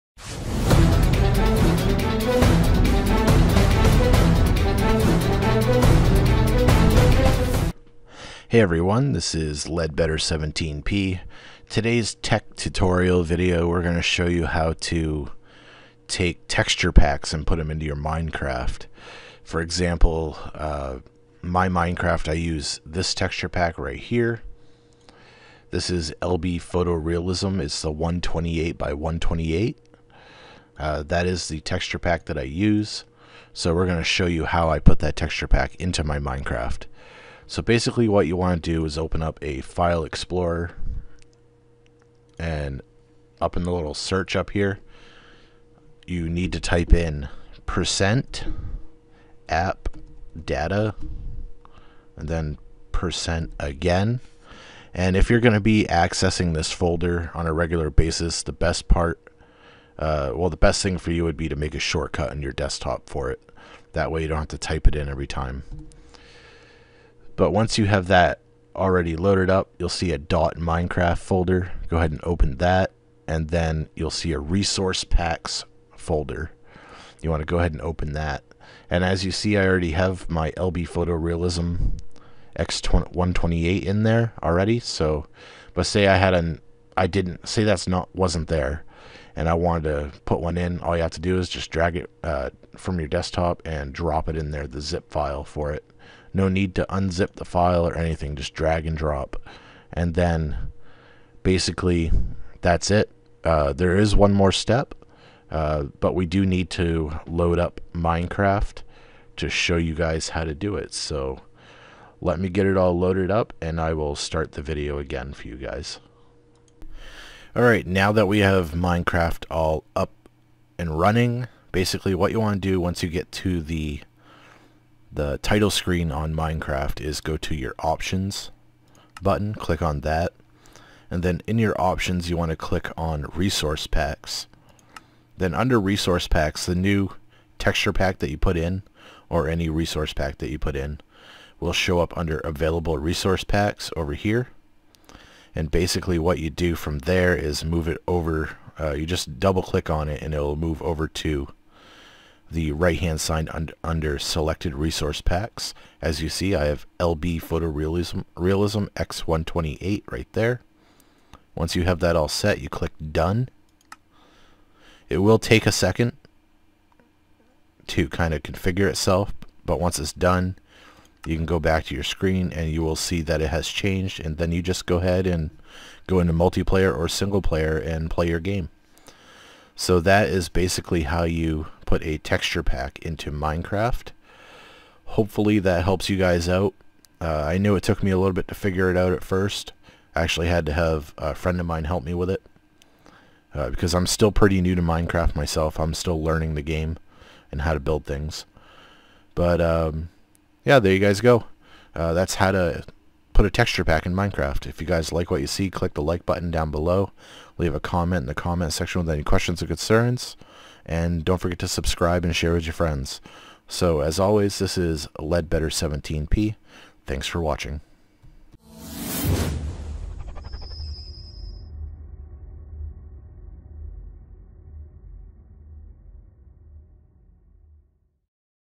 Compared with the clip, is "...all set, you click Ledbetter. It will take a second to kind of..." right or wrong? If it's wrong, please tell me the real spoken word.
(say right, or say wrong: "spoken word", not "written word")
wrong: "Done", not "Ledbetter".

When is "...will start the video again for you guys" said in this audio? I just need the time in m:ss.
1:53.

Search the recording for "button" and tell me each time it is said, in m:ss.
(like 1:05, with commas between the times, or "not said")
2:09, 3:26.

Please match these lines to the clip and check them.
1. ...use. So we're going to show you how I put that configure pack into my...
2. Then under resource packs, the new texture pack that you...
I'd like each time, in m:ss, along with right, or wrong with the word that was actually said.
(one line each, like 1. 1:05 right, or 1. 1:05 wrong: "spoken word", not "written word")
1. 0:32 wrong: "texture", not "configure"
2. 2:15 right.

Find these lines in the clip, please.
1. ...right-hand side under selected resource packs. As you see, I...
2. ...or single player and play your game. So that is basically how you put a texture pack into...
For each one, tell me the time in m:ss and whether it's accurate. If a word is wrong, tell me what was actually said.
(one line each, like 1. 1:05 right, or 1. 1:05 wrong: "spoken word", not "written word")
1. 2:32 right
2. 2:56 right.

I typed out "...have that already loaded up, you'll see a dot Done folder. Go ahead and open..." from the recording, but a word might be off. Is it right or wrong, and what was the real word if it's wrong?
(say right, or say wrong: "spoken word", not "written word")
wrong: "Minecraft", not "Done".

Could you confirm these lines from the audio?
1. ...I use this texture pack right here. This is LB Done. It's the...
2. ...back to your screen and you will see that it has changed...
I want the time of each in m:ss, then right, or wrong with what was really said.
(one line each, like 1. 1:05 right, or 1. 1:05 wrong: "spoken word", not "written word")
1. 0:22 wrong: "Photorealism", not "Done"
2. 2:51 right.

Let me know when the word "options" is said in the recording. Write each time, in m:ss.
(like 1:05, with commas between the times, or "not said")
2:07, 2:11.